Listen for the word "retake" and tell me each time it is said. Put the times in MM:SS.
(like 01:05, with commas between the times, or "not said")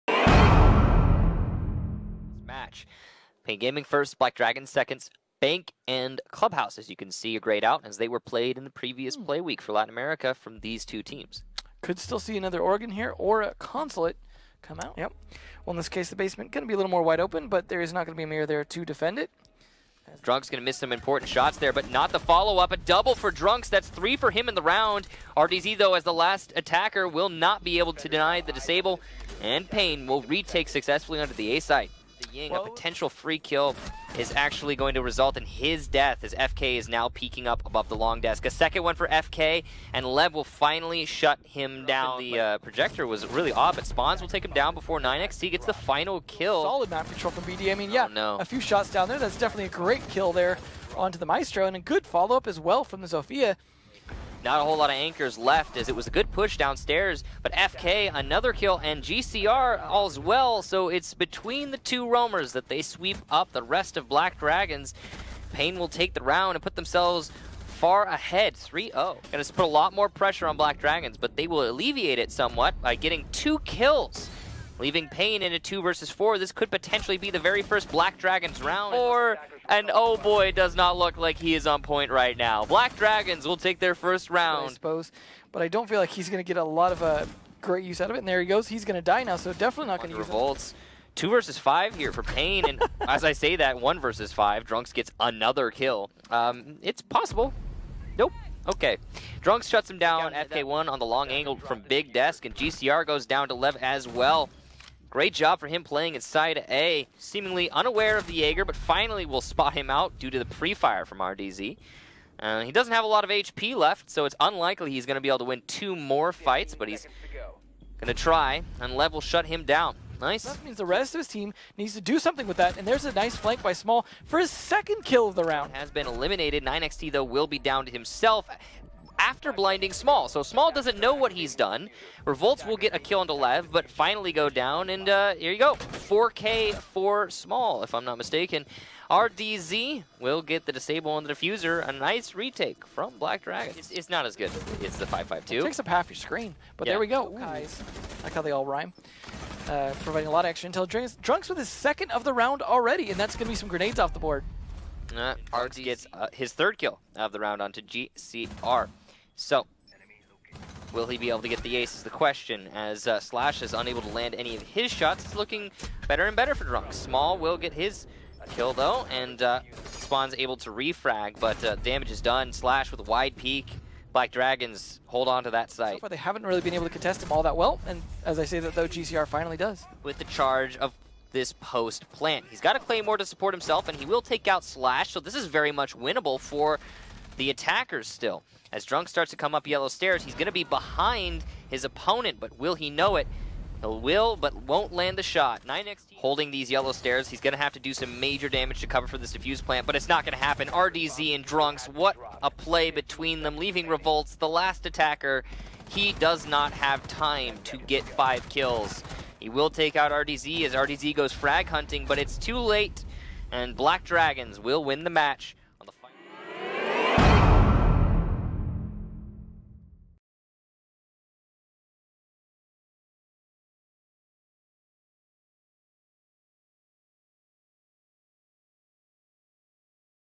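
00:30, 02:22.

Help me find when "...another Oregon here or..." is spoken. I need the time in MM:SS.
00:12.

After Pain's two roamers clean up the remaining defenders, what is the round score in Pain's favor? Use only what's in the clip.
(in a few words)
3-0.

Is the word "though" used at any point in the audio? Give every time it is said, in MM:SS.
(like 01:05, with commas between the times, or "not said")
00:25, 02:07, 02:48, 02:58.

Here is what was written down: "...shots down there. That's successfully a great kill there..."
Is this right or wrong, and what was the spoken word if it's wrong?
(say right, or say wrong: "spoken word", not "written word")
wrong: "definitely", not "successfully".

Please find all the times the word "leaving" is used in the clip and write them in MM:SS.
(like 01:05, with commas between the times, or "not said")
01:14, 03:23.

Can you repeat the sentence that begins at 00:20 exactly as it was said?
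Drunk's going to miss some important shots there, but not the follow-up.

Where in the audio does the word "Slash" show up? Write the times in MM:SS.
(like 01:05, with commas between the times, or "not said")
02:43, 02:52, 03:04.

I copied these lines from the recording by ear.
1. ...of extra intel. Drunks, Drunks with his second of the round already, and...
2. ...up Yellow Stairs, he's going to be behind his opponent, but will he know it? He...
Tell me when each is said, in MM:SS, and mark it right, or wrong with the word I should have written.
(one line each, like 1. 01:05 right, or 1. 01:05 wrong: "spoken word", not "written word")
1. 02:30 right
2. 03:09 right.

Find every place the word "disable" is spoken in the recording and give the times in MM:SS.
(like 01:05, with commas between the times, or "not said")
00:28, 02:20.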